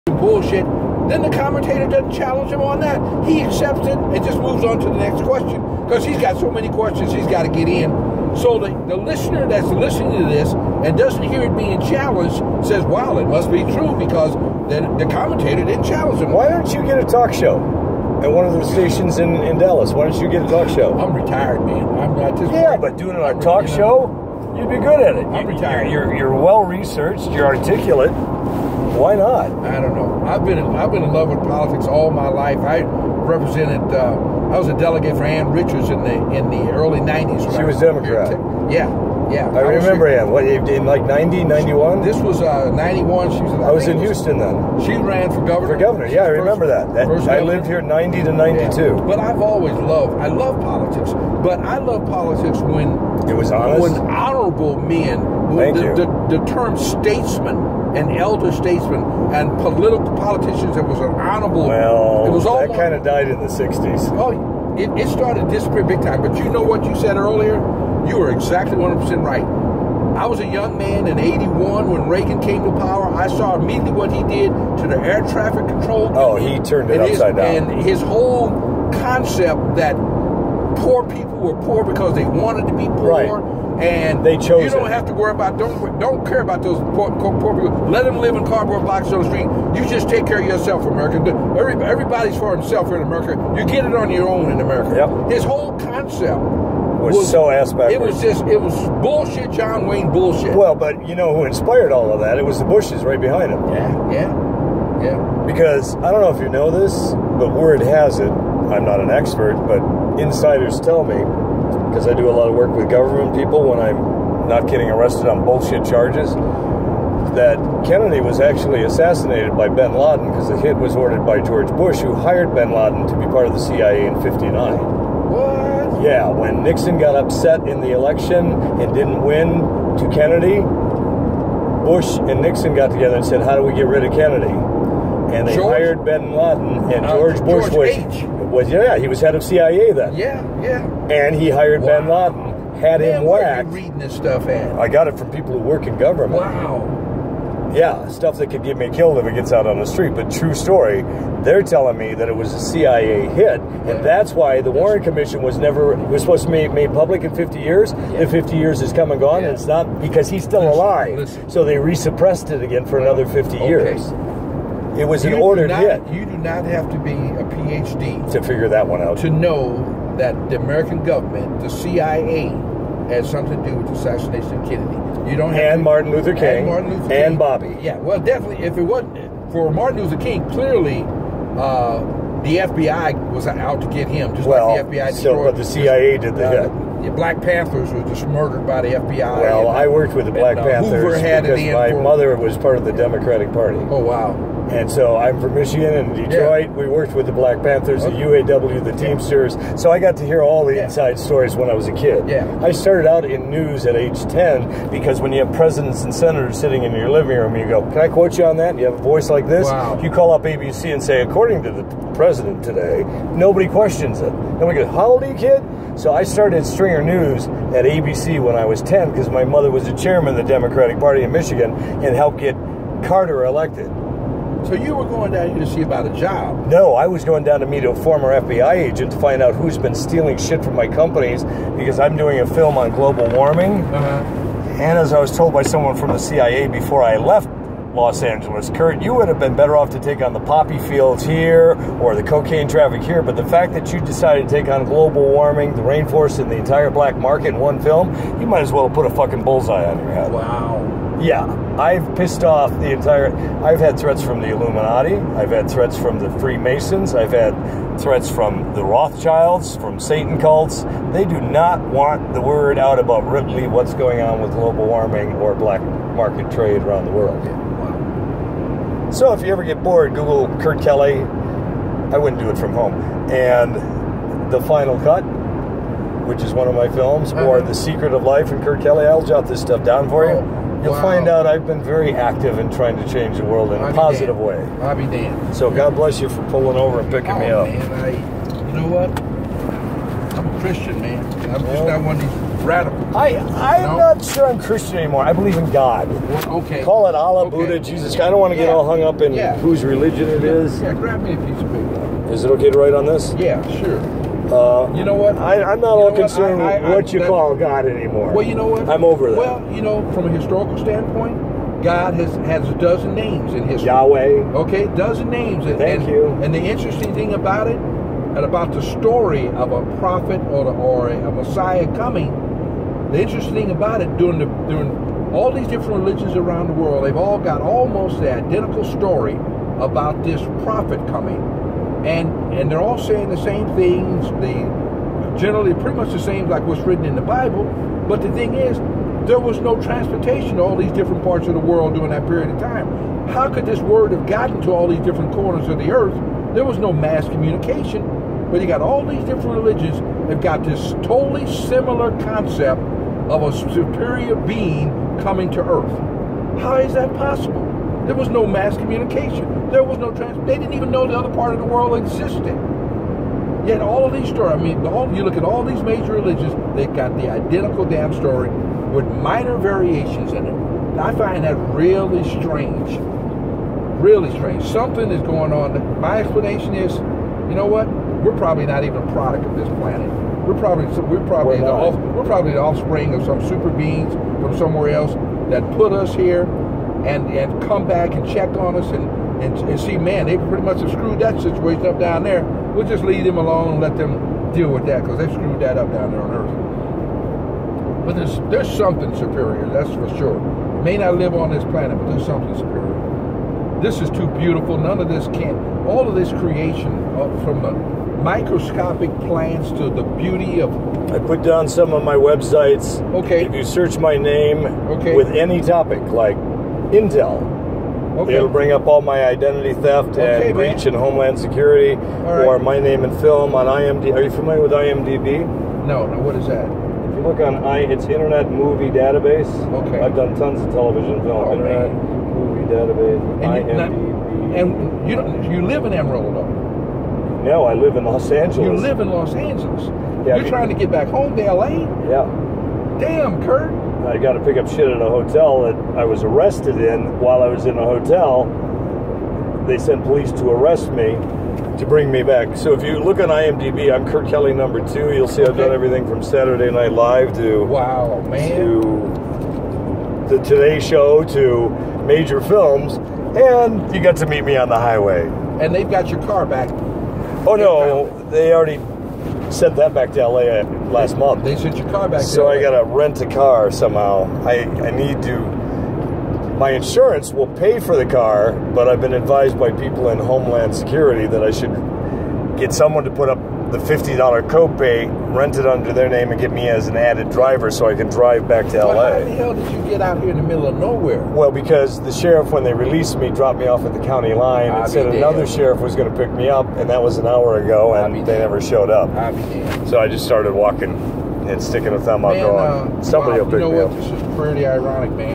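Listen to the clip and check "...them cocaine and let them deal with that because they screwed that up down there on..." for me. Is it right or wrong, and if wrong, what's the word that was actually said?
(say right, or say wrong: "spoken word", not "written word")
wrong: "alone", not "cocaine".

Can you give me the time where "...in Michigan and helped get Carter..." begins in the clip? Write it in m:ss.
3:41.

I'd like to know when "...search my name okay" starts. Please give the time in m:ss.
6:53.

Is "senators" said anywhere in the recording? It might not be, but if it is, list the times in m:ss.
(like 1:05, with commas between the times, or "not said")
3:26.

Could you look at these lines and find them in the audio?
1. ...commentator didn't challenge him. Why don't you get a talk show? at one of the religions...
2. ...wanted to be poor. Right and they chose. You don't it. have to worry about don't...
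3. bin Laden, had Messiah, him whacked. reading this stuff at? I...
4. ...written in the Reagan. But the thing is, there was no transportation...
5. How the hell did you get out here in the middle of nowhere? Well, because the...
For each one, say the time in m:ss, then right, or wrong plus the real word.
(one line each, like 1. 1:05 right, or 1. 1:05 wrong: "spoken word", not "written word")
1. 0:15 wrong: "stations", not "religions"
2. 1:22 right
3. 2:22 wrong: "Man", not "Messiah"
4. 5:36 wrong: "Bible", not "Reagan"
5. 8:09 right.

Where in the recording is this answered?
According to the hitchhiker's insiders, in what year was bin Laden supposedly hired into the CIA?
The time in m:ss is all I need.
2:04.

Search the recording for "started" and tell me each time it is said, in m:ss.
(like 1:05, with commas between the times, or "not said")
1:05, 3:22, 3:36, 8:20.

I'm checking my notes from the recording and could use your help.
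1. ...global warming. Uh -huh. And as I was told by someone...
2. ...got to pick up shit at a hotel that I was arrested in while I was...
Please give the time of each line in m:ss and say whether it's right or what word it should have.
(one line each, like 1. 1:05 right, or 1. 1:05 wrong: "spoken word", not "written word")
1. 3:52 right
2. 7:24 right.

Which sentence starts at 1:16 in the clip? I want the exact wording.
Oh, he turned it upside his, down.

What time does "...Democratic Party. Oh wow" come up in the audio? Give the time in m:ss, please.
3:12.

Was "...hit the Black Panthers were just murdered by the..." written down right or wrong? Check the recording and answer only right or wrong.
right.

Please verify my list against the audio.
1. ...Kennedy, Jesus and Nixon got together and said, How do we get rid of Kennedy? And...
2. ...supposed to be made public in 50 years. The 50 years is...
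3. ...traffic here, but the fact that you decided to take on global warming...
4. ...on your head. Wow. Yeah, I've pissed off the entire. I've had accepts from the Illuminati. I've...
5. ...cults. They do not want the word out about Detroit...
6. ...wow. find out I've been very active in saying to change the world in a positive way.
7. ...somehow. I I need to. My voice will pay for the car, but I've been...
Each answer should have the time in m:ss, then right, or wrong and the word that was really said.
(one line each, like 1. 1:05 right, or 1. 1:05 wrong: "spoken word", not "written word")
1. 2:10 wrong: "Bush", not "Jesus"
2. 2:36 right
3. 4:02 right
4. 4:09 wrong: "threats", not "accepts"
5. 4:20 wrong: "Ripley", not "Detroit"
6. 4:40 wrong: "trying", not "saying"
7. 7:53 wrong: "insurance", not "voice".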